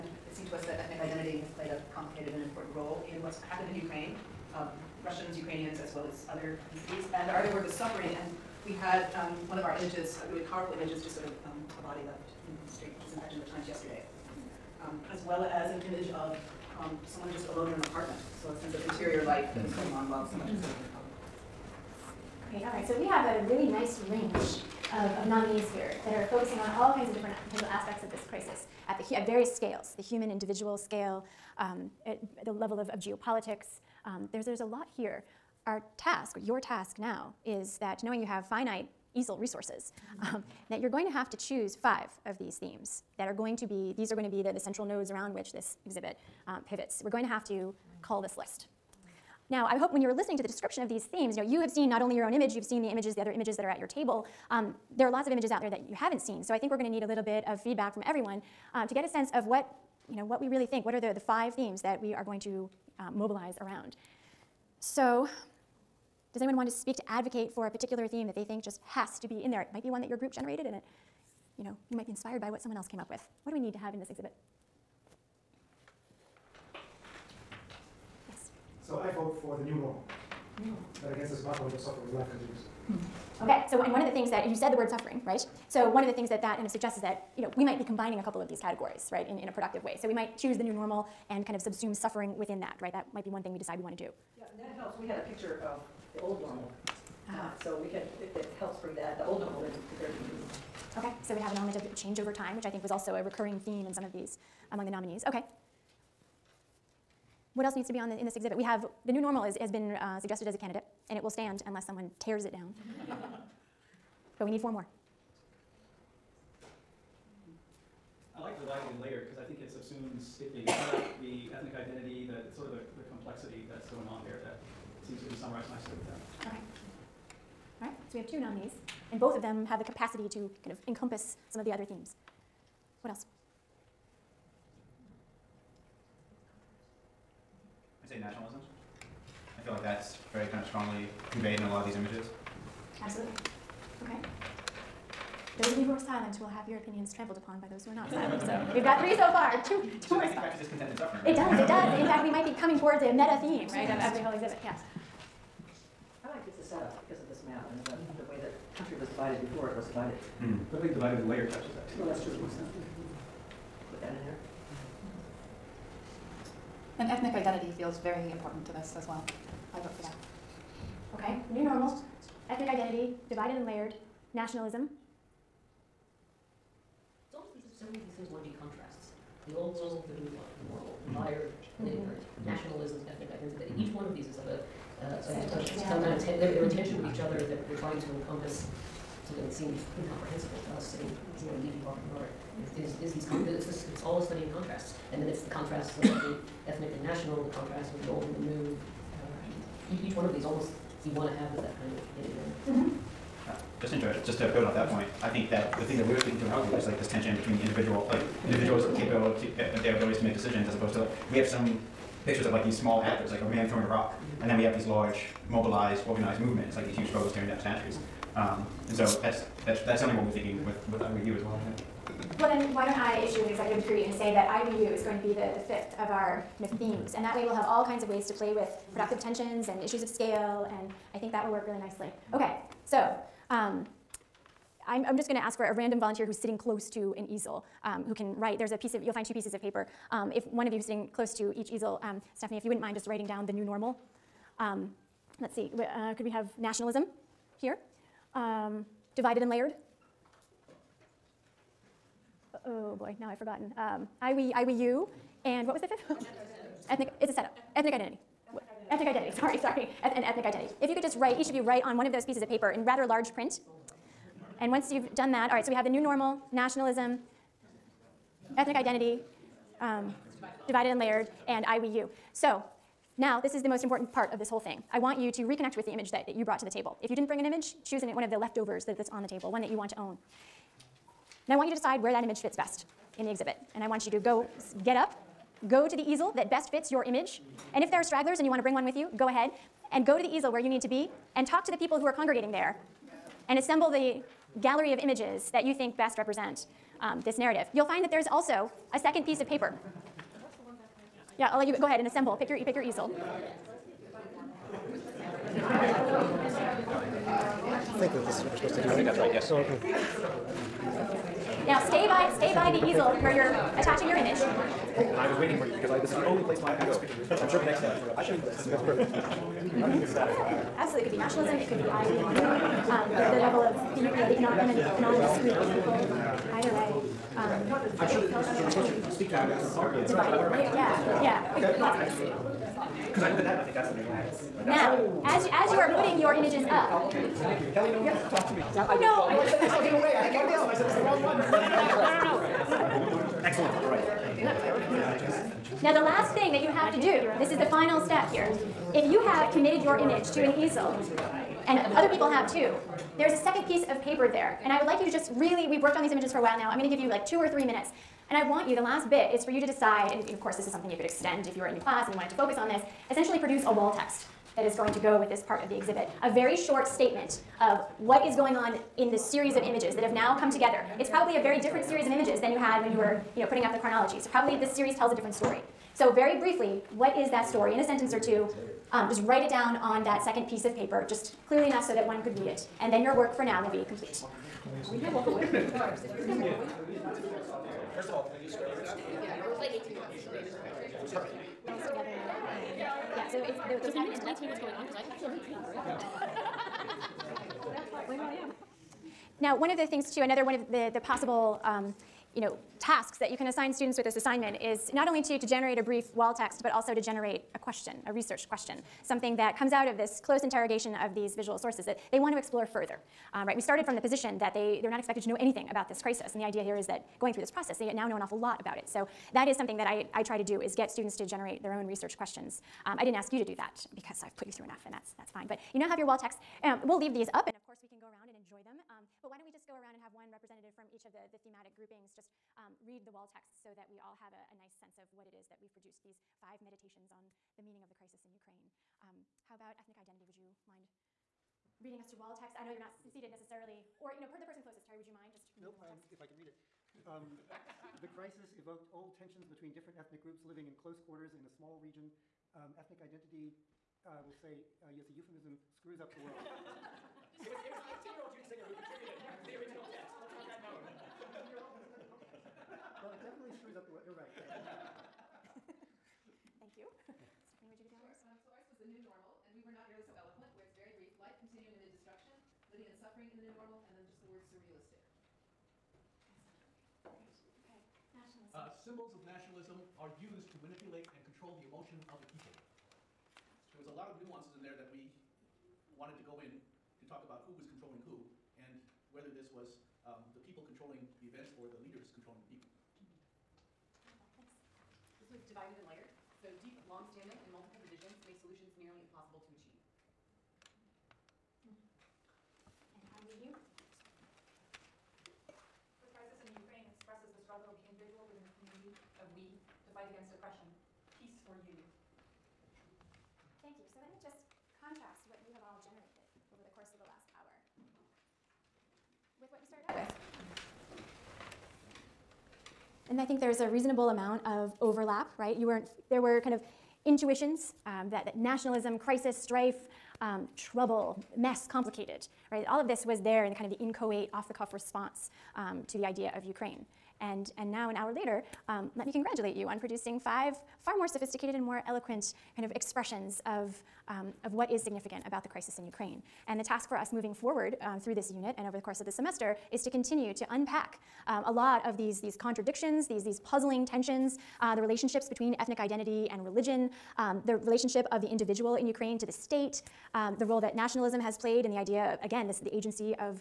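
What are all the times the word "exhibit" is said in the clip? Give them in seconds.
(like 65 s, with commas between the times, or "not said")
45 s, 74 s, 108 s, 154 s, 283 s, 365 s.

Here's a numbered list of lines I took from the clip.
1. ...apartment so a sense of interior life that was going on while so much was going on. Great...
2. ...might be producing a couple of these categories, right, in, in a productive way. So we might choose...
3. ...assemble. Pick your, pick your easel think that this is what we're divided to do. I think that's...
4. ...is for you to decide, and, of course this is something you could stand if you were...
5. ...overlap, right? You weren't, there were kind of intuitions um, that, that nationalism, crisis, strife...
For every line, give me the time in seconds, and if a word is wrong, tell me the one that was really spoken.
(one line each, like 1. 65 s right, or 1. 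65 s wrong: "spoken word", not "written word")
1. 17 s right
2. 87 s wrong: "combining", not "producing"
3. 302 s wrong: "supposed", not "divided"
4. 359 s wrong: "extend", not "stand"
5. 524 s right.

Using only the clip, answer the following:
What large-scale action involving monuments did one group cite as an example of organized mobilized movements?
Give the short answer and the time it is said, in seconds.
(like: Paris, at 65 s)
Tearing down statues, at 217 s.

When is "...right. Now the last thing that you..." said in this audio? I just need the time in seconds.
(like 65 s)
345 s.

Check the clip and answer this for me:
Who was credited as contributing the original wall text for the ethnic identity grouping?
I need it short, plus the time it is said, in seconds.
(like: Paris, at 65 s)
Judy Singer, at 458 s.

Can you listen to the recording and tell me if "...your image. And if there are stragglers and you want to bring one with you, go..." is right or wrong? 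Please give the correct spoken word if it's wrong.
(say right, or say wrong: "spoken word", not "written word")
right.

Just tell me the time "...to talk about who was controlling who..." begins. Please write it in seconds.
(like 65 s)
486 s.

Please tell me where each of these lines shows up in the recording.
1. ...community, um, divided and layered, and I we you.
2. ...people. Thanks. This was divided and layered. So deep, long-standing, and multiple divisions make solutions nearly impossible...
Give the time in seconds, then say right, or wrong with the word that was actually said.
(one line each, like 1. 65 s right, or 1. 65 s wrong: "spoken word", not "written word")
1. 268 s wrong: "identity", not "community"
2. 492 s right.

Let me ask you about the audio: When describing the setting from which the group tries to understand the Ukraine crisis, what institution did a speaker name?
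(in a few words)
Harvard.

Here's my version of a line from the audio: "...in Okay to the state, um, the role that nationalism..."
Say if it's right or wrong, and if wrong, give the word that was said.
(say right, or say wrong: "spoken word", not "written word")
wrong: "Ukraine", not "Okay".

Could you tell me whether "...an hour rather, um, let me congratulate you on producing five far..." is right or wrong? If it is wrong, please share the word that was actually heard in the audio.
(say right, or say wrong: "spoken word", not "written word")
wrong: "later", not "rather".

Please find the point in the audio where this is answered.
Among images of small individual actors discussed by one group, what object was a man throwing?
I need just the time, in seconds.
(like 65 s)
213 s.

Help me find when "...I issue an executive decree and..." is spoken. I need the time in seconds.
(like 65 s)
222 s.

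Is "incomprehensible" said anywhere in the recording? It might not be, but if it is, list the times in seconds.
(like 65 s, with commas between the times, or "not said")
189 s.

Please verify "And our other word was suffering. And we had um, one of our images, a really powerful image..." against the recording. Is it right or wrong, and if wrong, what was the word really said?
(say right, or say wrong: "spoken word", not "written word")
right.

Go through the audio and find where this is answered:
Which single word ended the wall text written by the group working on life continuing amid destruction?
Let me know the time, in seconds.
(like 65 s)
474 s.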